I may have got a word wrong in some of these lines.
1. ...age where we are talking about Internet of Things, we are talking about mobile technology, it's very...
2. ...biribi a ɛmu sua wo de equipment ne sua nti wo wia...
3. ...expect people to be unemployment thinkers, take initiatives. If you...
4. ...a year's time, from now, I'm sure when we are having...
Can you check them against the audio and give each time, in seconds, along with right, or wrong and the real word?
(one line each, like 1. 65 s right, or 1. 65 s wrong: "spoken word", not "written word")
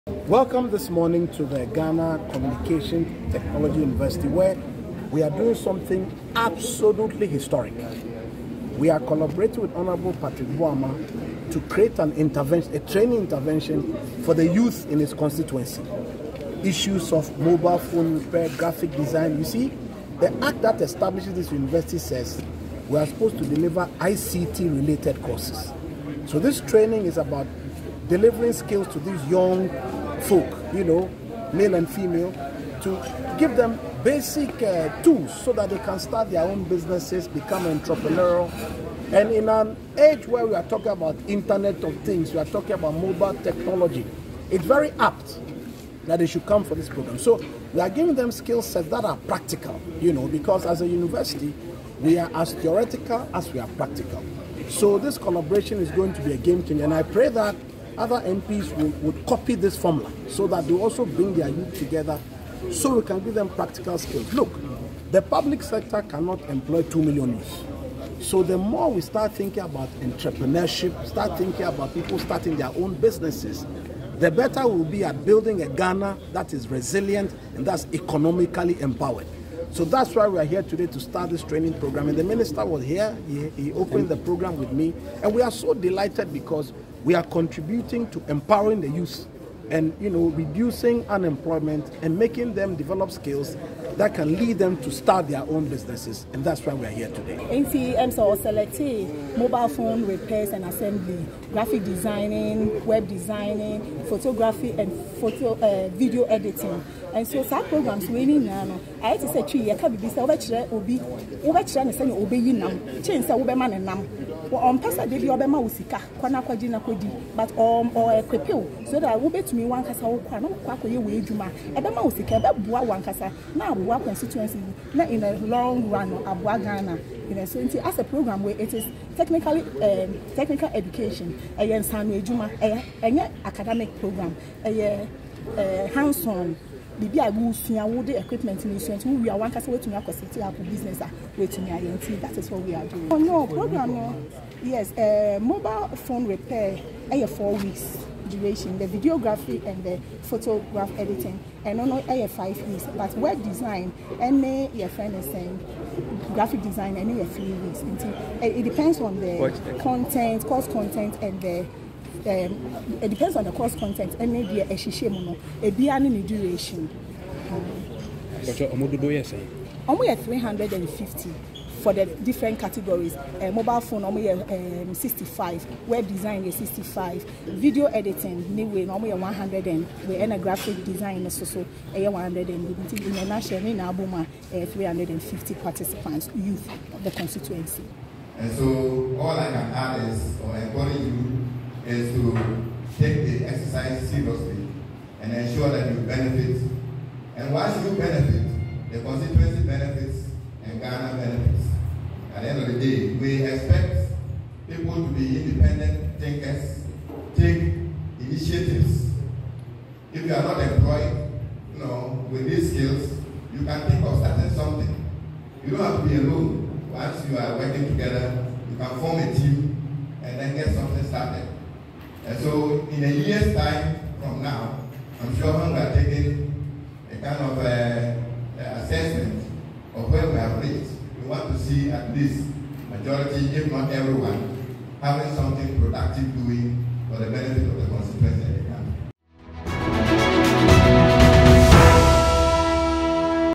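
1. 39 s right
2. 137 s right
3. 203 s wrong: "independent", not "unemployment"
4. 223 s wrong: "taking", not "having".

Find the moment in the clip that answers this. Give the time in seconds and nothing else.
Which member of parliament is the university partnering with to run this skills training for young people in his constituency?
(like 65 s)
10 s.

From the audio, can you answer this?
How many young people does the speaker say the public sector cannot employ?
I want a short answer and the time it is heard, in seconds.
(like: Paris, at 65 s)
2 million, at 66 s.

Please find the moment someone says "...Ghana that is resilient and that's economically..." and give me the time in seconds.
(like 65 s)
75 s.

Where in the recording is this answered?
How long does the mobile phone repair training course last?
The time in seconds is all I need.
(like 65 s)
147 s.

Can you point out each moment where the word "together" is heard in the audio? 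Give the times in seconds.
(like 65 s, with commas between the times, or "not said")
61 s, 217 s.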